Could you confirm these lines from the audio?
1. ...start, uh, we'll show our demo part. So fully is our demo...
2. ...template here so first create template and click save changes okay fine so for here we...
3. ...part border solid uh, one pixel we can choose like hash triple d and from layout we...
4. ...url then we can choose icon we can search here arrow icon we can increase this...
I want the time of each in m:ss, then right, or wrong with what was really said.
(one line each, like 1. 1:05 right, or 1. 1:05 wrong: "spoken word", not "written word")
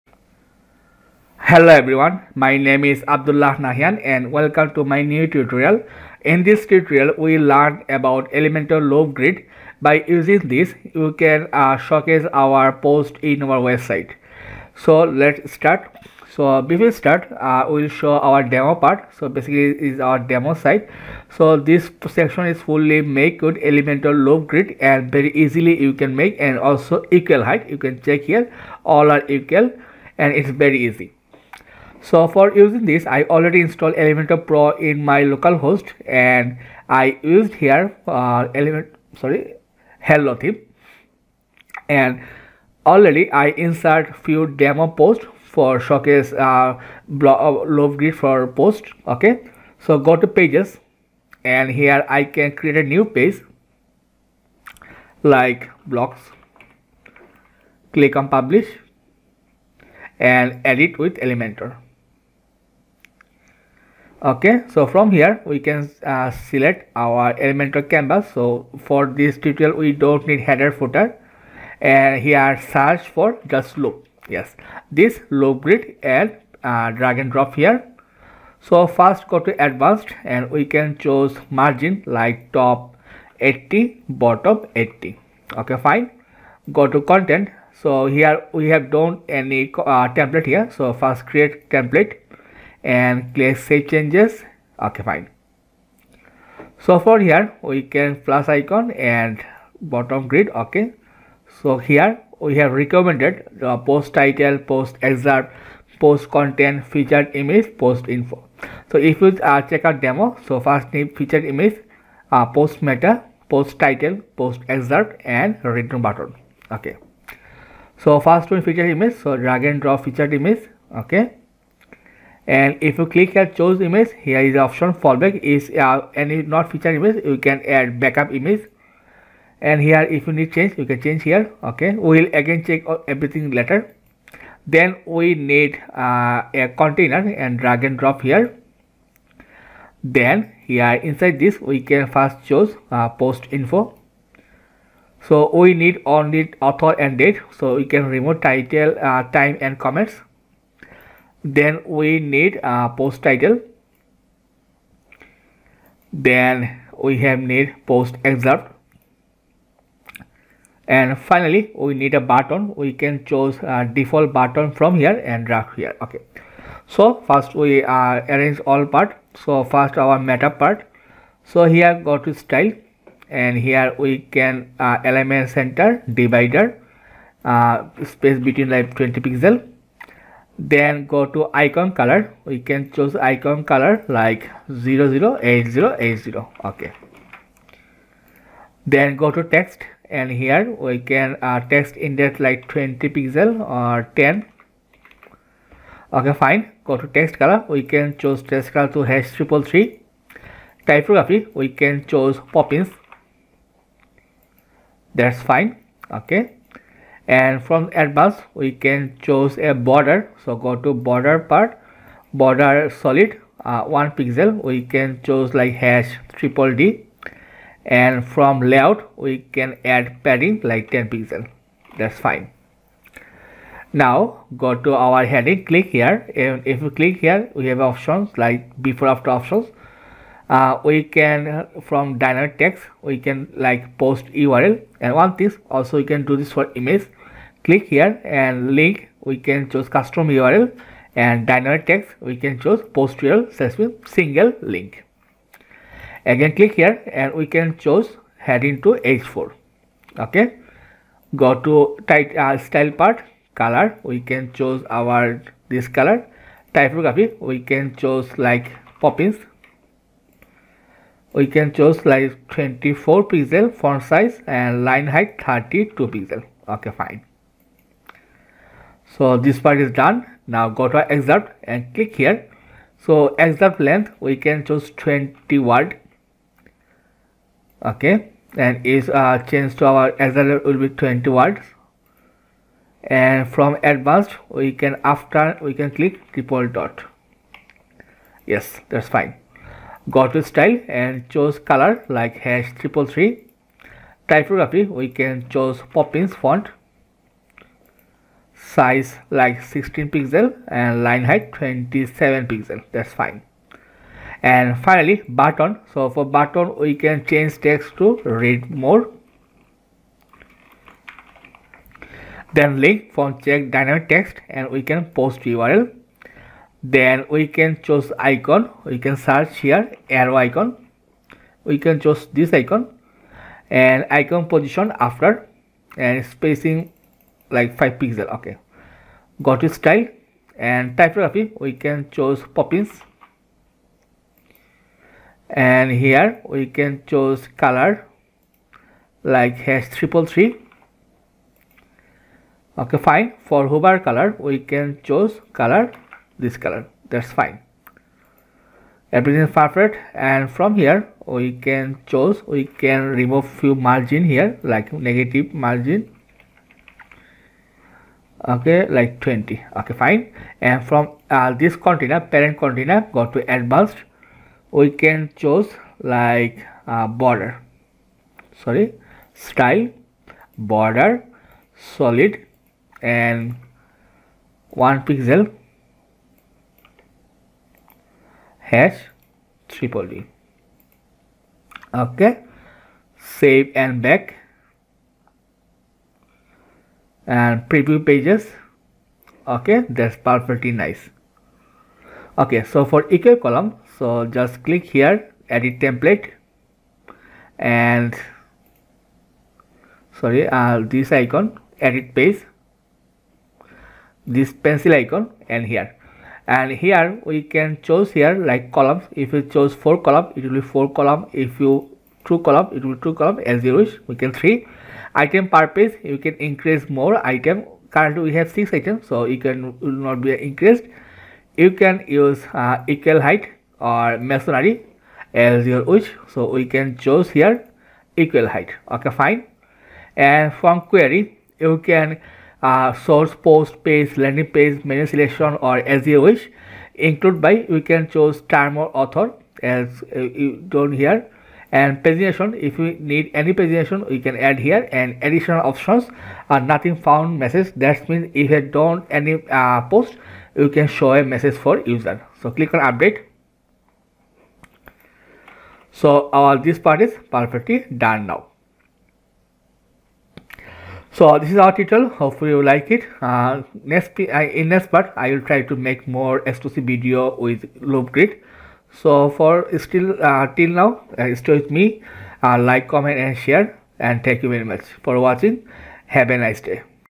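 1. 0:16 wrong: "basically", not "fully"
2. 1:30 right
3. 3:31 right
4. 5:15 wrong: "choose", not "increase".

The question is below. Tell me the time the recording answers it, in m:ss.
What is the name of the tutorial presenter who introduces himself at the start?
0:03.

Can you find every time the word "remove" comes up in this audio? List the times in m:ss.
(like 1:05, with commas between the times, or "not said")
2:28, 5:53.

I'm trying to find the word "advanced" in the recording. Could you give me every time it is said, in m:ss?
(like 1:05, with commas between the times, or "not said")
1:19, 3:28, 4:43, 6:03.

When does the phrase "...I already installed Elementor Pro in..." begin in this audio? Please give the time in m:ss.
0:33.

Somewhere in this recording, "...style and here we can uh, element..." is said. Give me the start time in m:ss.
2:52.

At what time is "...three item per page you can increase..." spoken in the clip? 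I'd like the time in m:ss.
6:54.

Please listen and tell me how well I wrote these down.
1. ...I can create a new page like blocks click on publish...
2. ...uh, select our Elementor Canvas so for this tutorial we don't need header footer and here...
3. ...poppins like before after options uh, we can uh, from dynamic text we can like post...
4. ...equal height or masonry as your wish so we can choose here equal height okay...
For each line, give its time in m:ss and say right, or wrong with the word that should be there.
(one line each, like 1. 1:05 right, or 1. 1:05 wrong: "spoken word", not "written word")
1. 0:52 right
2. 1:06 right
3. 3:47 wrong: "options", not "poppins"
4. 7:02 right.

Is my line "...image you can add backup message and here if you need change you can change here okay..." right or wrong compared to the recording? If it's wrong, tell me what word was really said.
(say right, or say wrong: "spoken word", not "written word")
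wrong: "image", not "message".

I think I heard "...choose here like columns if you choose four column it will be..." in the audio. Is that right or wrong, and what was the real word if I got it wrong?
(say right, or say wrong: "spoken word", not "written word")
right.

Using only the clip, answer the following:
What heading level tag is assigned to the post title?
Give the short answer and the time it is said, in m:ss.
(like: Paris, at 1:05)
H4, at 4:09.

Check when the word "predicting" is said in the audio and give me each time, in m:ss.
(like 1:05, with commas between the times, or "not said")
not said.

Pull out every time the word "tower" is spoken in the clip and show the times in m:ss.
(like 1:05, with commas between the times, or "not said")
not said.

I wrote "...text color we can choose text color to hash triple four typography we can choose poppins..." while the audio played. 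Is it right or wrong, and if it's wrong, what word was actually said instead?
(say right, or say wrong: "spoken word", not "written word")
wrong: "three", not "four".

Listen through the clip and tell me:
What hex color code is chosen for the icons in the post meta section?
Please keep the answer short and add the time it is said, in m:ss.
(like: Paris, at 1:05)
008080, at 3:04.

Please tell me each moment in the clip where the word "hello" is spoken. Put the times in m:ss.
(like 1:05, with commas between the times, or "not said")
0:01, 0:39.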